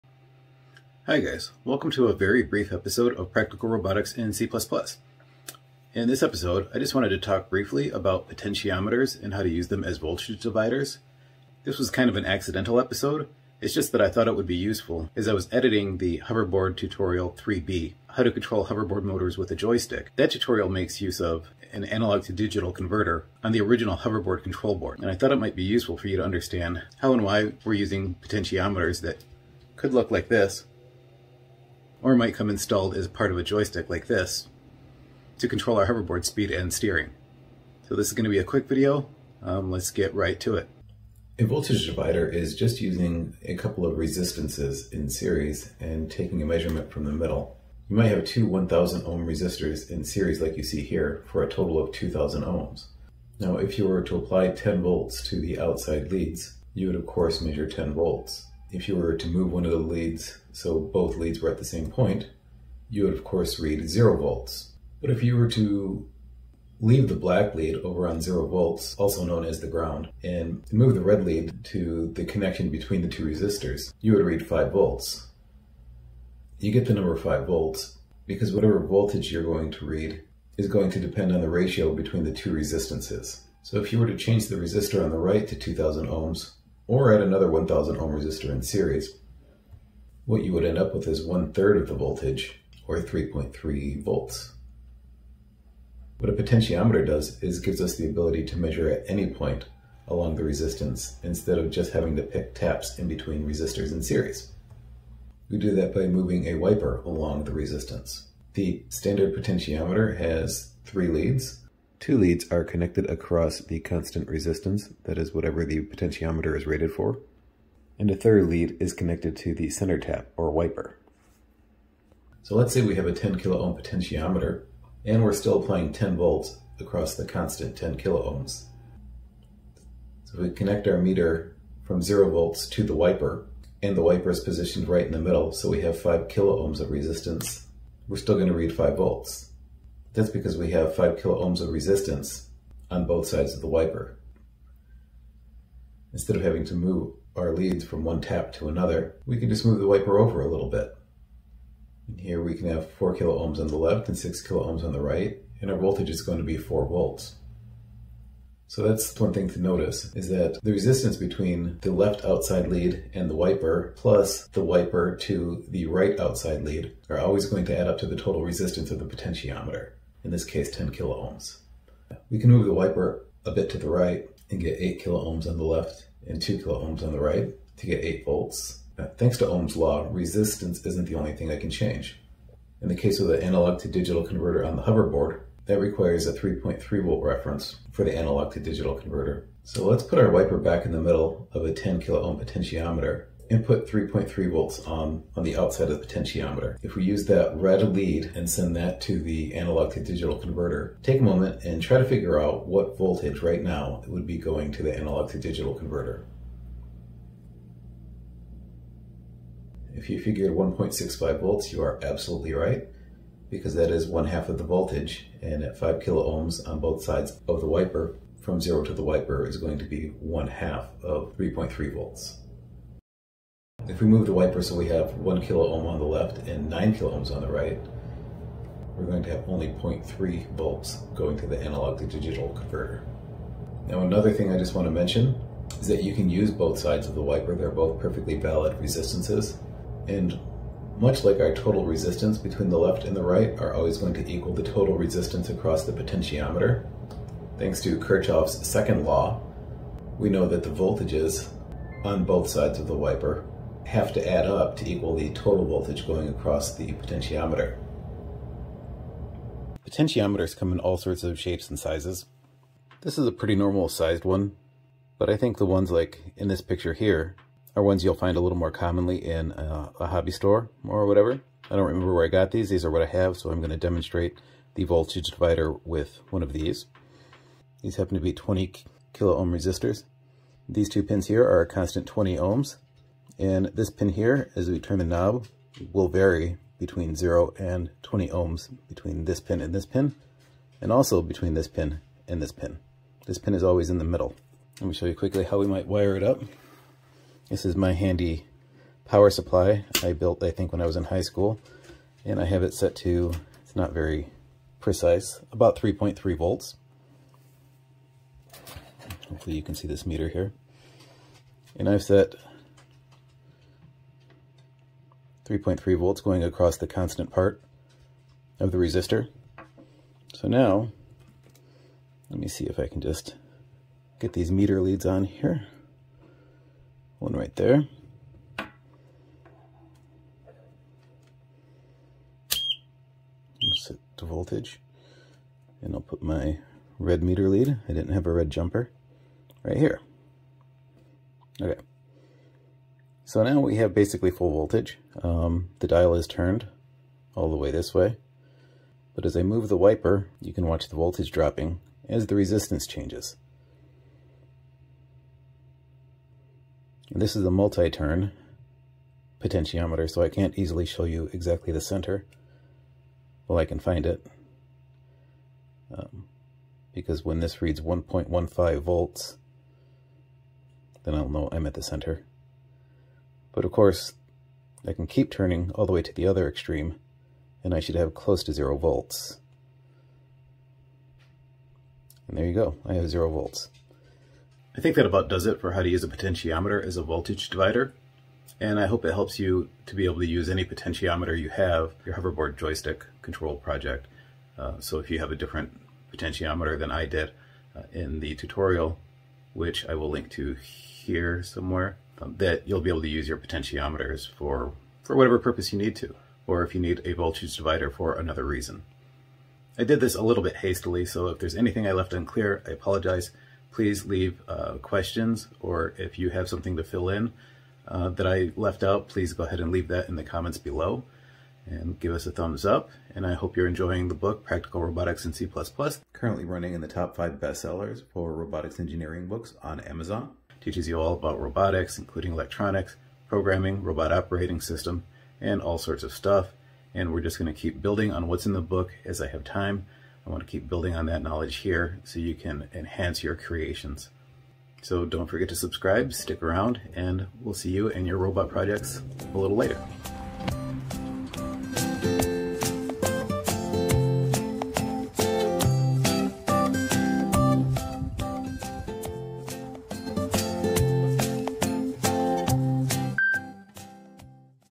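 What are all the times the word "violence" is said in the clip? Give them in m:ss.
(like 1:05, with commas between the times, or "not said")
not said.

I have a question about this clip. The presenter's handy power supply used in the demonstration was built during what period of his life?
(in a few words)
high school.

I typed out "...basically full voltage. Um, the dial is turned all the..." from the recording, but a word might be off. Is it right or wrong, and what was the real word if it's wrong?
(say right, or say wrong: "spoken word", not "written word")
right.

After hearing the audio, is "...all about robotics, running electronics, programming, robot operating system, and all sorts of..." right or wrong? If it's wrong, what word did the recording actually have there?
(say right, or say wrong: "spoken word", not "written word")
wrong: "including", not "running".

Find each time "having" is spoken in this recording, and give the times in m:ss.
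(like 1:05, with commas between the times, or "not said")
1:41, 2:26.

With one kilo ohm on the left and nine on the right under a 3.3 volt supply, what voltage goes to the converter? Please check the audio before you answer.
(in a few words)
0.3 volts.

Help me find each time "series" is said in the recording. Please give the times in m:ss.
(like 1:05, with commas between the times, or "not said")
0:45, 0:50, 1:28, 1:44.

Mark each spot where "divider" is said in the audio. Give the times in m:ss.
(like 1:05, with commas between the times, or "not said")
0:10, 0:41, 4:35, 6:27, 6:47.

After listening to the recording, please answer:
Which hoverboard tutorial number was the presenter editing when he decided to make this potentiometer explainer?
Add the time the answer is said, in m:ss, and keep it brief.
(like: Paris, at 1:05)
3B, at 0:17.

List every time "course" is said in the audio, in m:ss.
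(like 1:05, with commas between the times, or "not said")
0:57, 1:03, 6:13.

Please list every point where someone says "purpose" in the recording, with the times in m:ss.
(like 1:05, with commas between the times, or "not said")
6:45.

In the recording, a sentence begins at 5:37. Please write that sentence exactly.
I didn't have a red jumper.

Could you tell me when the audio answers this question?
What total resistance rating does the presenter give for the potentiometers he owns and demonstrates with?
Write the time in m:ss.
4:38.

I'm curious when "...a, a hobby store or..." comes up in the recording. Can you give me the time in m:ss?
4:29.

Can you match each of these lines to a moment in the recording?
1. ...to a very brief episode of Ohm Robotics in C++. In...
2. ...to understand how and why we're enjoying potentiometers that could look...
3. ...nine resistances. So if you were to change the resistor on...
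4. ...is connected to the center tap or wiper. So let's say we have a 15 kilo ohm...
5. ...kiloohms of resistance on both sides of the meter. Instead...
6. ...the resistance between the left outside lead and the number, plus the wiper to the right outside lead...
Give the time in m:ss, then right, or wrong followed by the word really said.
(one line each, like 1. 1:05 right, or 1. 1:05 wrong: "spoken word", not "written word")
1. 0:01 wrong: "Practical", not "Ohm"
2. 0:26 wrong: "using", not "enjoying"
3. 1:22 wrong: "two", not "nine"
4. 1:58 wrong: "10", not "15"
5. 2:21 wrong: "wiper", not "meter"
6. 2:40 wrong: "wiper", not "number".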